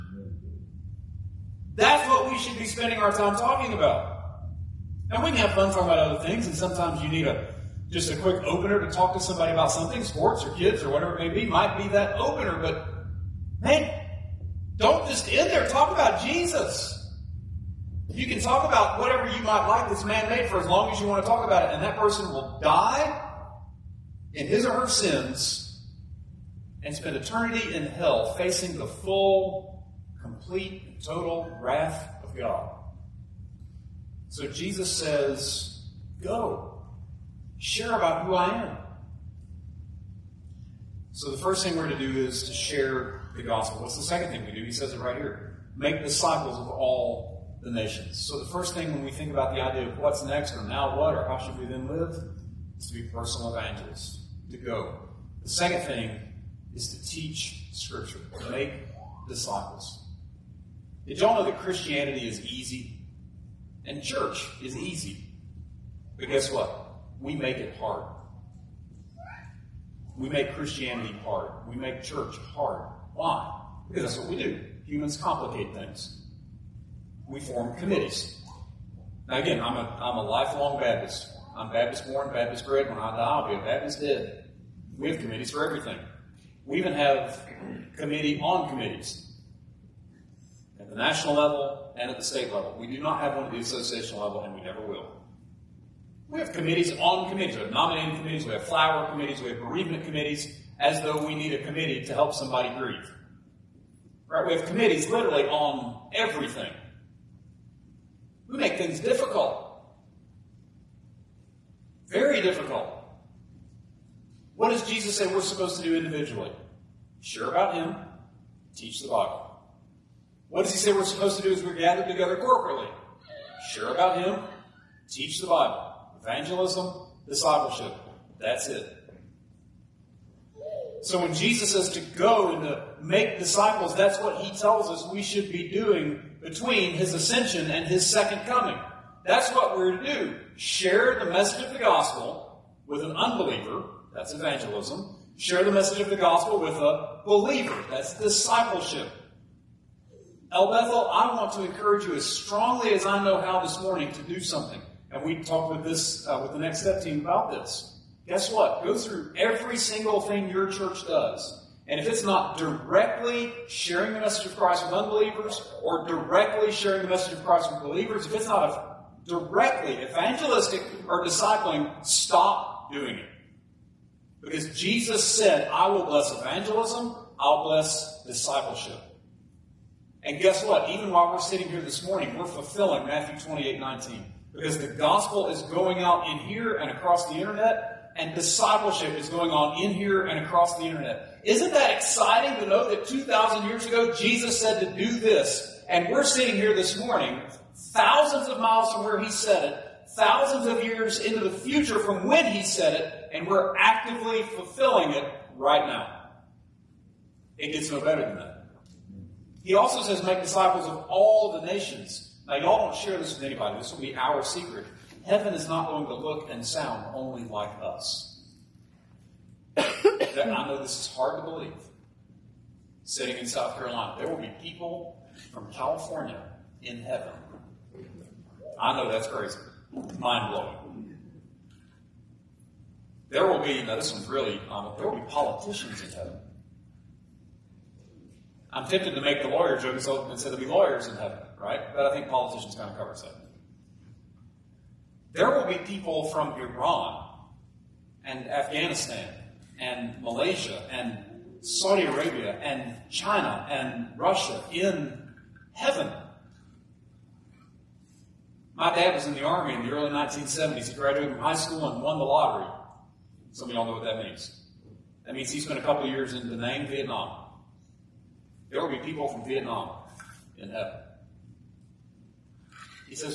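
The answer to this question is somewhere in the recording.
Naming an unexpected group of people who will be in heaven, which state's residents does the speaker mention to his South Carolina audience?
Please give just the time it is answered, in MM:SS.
03:45.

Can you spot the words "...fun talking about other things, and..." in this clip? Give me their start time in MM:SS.
00:05.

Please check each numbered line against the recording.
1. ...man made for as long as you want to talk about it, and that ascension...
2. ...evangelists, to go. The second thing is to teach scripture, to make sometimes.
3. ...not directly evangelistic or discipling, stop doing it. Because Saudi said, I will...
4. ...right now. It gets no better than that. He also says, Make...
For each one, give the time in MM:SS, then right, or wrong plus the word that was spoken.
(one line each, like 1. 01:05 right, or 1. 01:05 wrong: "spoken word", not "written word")
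1. 00:20 wrong: "person", not "ascension"
2. 00:53 wrong: "disciples", not "sometimes"
3. 02:48 wrong: "Jesus", not "Saudi"
4. 03:25 right.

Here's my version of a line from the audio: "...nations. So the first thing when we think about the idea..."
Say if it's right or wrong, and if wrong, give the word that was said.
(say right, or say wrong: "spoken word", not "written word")
right.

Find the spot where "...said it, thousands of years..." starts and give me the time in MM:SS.
03:19.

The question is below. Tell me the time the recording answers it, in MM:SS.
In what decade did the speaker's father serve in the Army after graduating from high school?
04:19.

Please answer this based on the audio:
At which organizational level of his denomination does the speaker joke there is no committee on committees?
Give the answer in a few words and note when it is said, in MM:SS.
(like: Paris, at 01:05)
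Association level, at 01:33.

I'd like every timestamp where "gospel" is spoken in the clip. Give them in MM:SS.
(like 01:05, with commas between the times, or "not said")
00:43, 02:21, 02:26, 03:04.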